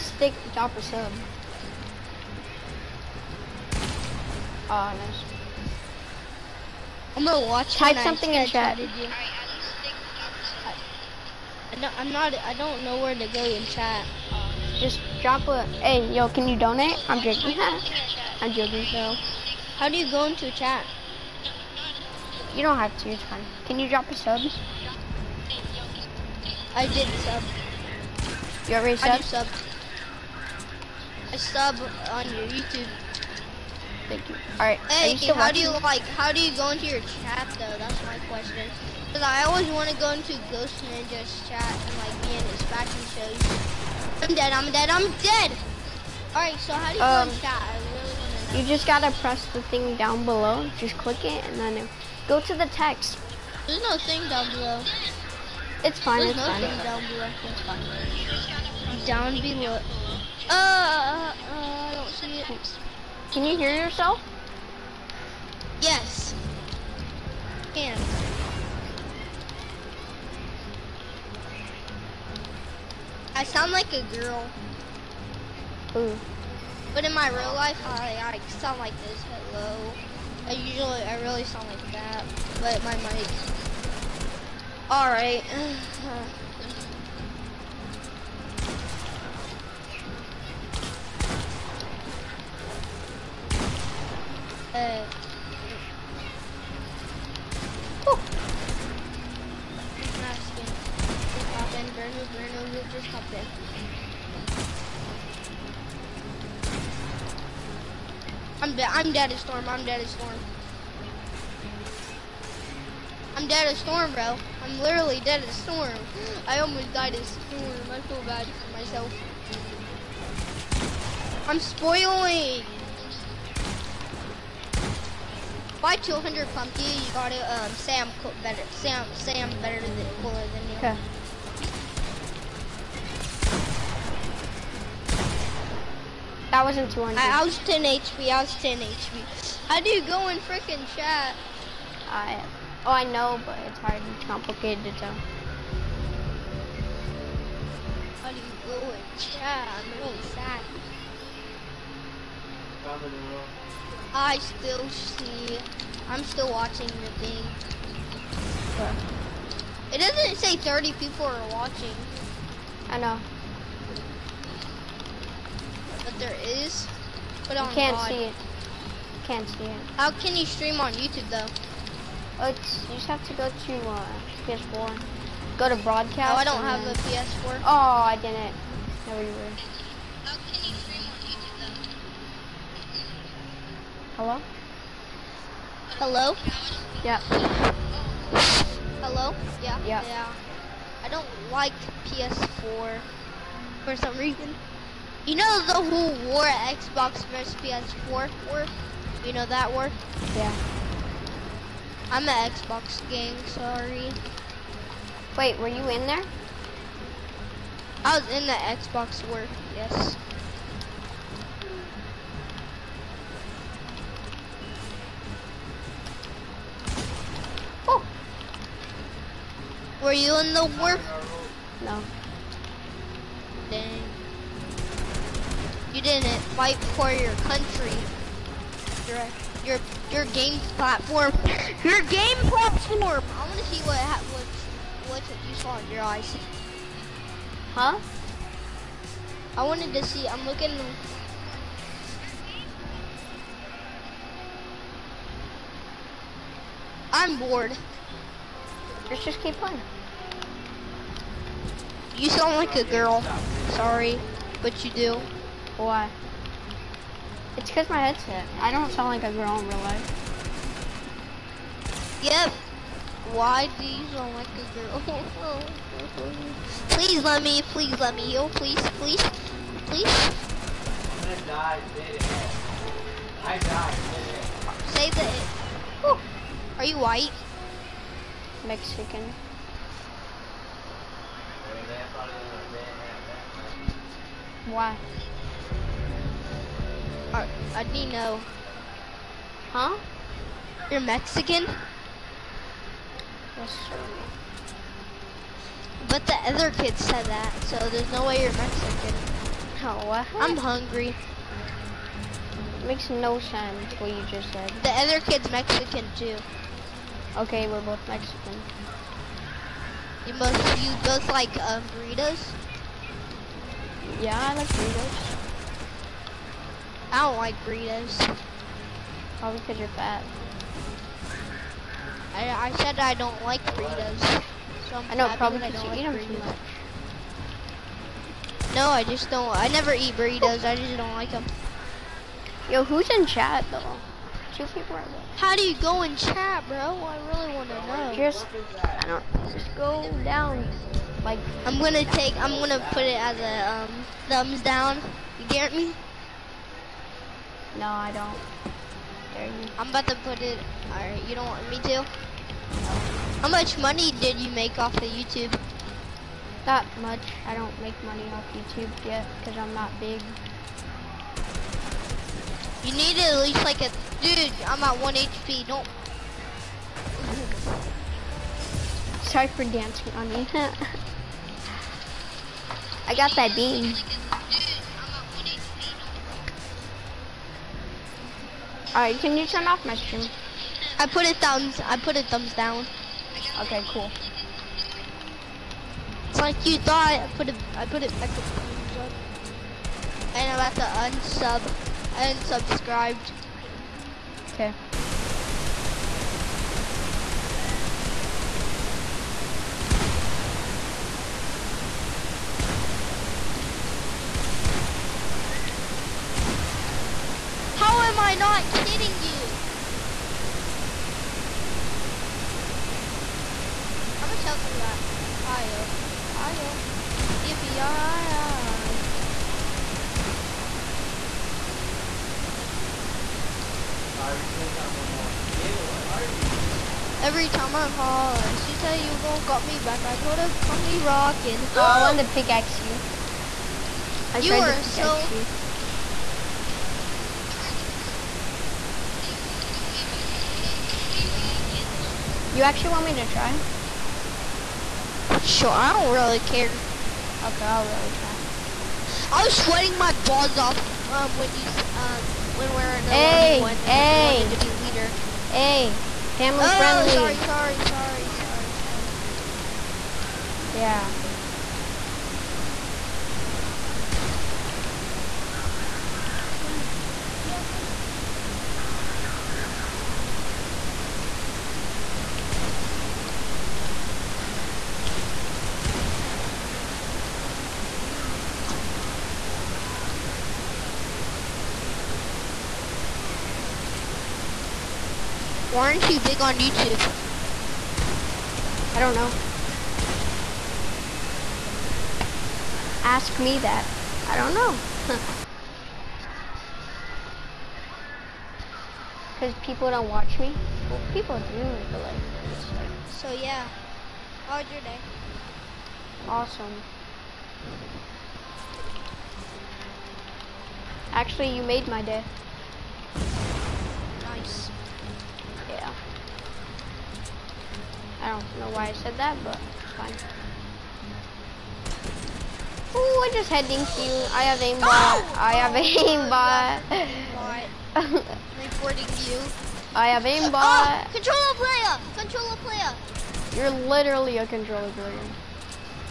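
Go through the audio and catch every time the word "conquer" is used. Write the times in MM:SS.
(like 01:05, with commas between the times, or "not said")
not said.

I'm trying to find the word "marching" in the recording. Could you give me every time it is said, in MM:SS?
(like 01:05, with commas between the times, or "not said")
not said.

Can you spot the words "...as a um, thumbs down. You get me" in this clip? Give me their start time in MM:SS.
05:43.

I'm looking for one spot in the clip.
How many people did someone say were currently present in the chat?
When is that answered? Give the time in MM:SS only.
05:34.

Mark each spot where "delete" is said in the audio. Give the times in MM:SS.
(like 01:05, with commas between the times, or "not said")
not said.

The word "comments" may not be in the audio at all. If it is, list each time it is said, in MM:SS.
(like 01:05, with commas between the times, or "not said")
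not said.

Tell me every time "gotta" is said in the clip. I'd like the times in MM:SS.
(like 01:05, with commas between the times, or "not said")
00:48.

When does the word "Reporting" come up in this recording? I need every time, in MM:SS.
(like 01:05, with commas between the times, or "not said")
08:48.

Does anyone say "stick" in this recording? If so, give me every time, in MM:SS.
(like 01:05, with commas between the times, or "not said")
00:00.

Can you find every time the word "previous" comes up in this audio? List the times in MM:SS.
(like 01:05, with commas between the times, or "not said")
not said.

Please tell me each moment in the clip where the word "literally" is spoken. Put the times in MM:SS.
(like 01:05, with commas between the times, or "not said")
01:54, 08:53.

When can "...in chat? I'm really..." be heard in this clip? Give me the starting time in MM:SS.
02:28.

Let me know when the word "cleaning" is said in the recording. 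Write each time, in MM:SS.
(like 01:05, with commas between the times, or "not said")
not said.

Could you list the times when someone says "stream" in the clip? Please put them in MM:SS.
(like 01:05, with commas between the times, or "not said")
02:50, 03:00, 06:19.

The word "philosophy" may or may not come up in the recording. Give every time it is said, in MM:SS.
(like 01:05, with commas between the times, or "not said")
not said.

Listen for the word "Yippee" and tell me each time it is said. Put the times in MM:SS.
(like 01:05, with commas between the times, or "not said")
06:57.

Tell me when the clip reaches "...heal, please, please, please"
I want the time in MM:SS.
04:28.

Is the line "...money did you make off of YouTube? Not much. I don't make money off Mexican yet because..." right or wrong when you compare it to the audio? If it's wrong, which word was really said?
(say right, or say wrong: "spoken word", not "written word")
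wrong: "YouTube", not "Mexican".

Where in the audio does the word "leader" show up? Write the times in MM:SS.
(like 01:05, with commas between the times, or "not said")
07:34.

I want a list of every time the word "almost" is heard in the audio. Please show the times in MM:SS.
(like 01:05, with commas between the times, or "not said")
01:56.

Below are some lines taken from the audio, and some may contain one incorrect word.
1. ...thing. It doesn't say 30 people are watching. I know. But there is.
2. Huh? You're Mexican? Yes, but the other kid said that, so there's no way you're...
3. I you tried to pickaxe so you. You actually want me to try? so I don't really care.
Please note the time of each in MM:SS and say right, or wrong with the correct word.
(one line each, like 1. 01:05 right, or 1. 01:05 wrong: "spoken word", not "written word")
1. 02:37 right
2. 04:49 right
3. 07:14 right.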